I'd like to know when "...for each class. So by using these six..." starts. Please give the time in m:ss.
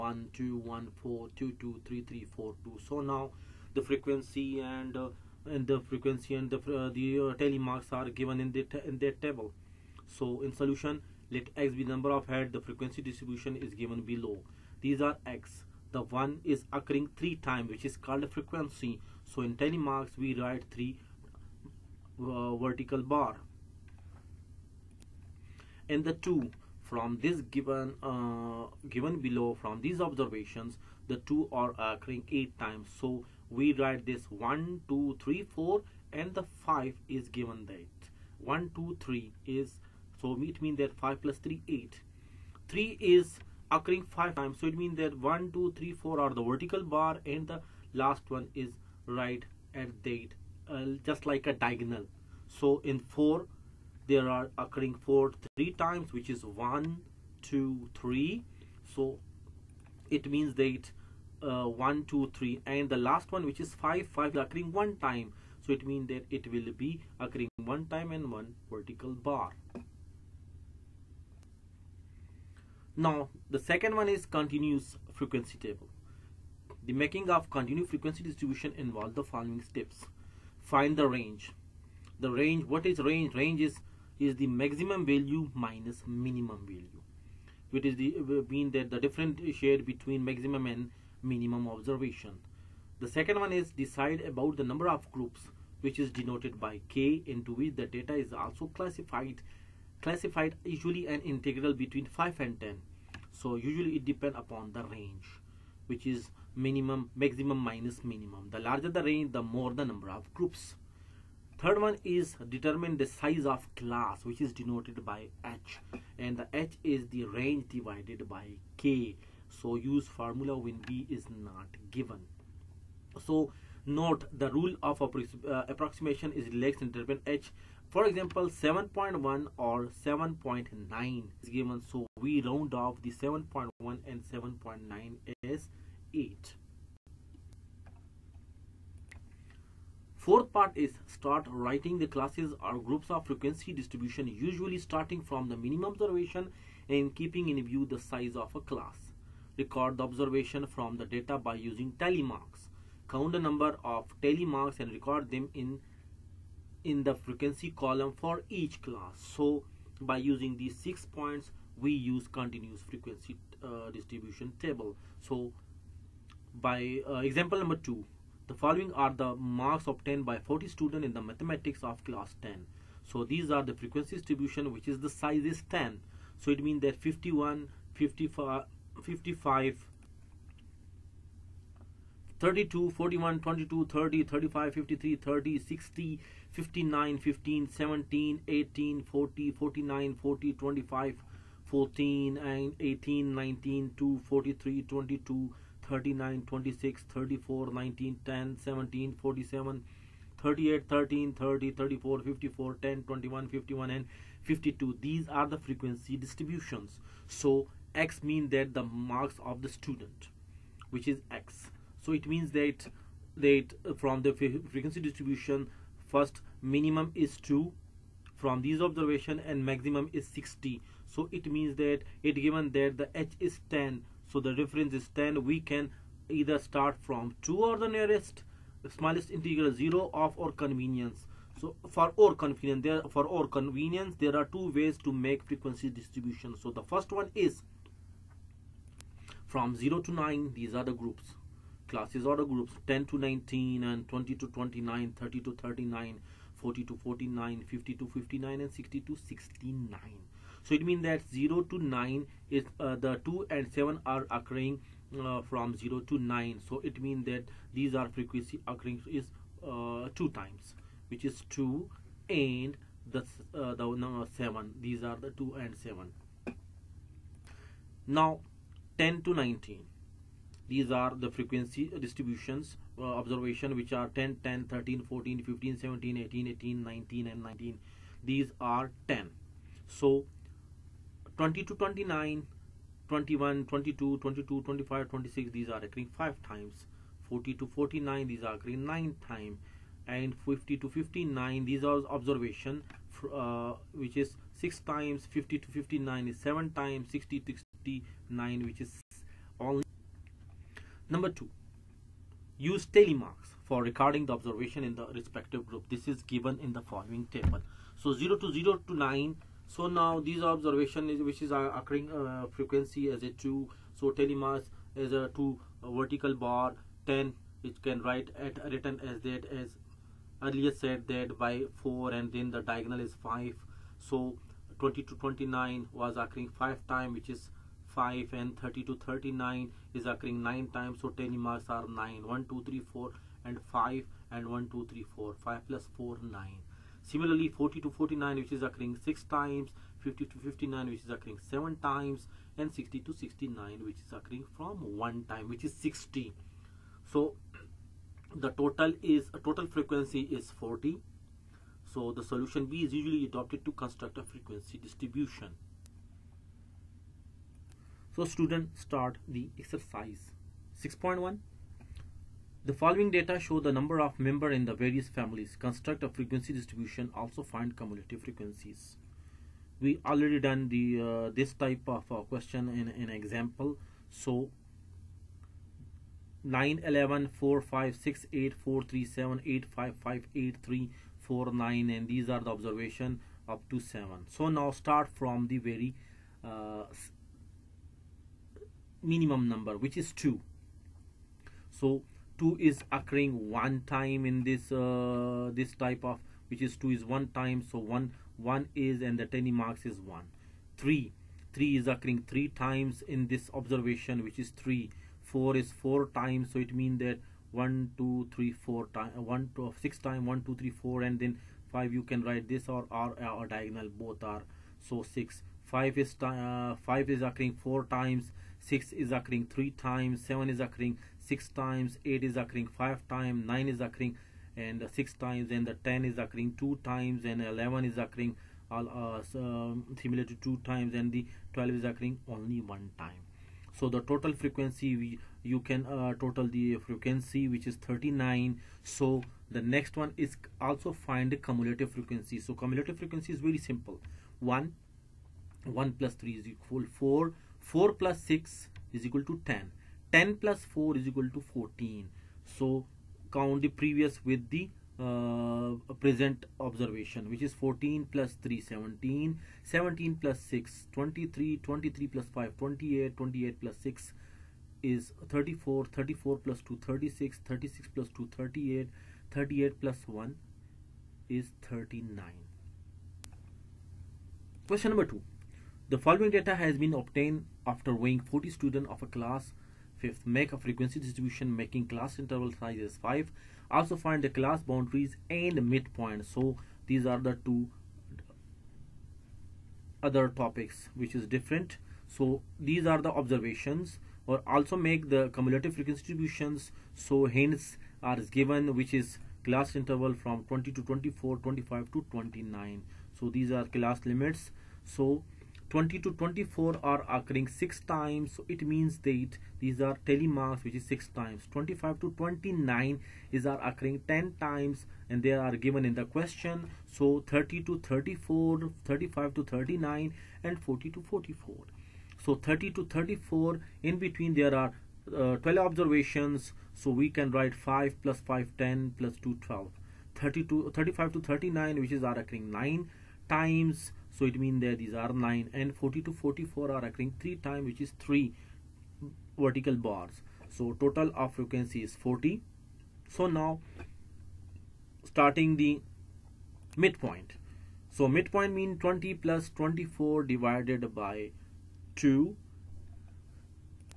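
2:38.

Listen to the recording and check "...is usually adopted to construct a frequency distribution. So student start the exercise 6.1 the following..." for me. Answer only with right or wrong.
right.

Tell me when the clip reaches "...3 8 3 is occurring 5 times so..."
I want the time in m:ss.
0:41.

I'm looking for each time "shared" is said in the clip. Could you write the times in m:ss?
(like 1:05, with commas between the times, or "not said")
1:29.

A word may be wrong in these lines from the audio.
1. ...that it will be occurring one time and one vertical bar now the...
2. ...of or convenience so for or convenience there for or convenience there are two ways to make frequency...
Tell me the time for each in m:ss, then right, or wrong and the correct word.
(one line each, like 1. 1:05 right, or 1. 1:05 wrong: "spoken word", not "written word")
1. 1:06 right
2. 3:50 right.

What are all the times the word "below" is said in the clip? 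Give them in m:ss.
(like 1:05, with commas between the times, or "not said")
0:14, 0:29.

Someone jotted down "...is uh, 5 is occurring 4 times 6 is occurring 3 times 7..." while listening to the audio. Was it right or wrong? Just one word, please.
right.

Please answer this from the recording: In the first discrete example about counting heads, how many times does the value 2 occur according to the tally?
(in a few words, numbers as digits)
8.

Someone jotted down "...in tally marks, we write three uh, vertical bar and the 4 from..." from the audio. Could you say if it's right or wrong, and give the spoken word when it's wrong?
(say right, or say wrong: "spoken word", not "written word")
wrong: "2", not "4".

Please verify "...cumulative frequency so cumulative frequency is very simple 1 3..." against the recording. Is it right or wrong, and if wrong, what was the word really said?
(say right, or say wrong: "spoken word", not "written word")
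wrong: "1", not "3".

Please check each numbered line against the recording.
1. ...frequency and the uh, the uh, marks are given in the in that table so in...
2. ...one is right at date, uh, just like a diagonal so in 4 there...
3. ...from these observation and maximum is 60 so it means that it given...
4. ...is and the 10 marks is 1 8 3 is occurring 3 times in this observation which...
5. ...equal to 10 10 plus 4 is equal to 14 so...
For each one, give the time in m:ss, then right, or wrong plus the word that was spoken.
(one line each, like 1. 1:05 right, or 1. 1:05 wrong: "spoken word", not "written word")
1. 0:05 right
2. 0:48 right
3. 3:38 right
4. 6:38 wrong: "3", not "8"
5. 7:29 right.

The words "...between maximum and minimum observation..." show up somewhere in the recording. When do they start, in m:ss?
1:29.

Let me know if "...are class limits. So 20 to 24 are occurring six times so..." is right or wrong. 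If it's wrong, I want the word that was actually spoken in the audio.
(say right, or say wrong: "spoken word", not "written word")
right.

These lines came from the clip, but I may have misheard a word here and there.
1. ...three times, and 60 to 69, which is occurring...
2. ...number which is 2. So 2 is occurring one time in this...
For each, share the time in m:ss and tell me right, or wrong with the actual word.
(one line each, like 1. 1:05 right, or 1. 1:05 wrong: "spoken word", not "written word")
1. 5:41 wrong: "seven", not "three"
2. 6:29 right.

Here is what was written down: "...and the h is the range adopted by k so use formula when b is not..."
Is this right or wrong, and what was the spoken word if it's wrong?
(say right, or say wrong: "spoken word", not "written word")
wrong: "divided", not "adopted".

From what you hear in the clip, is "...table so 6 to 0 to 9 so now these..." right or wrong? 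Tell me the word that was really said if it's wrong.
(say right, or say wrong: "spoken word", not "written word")
wrong: "0", not "6".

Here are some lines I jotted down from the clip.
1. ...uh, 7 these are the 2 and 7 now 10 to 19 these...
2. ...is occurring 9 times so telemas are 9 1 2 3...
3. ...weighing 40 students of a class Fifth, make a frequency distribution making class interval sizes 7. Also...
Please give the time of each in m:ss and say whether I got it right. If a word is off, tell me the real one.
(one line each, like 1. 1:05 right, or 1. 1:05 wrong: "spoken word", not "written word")
1. 4:24 right
2. 5:30 right
3. 7:58 wrong: "5", not "7".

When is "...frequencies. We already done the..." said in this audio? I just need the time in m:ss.
6:08.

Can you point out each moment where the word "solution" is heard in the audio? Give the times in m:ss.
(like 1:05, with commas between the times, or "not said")
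0:10, 5:52.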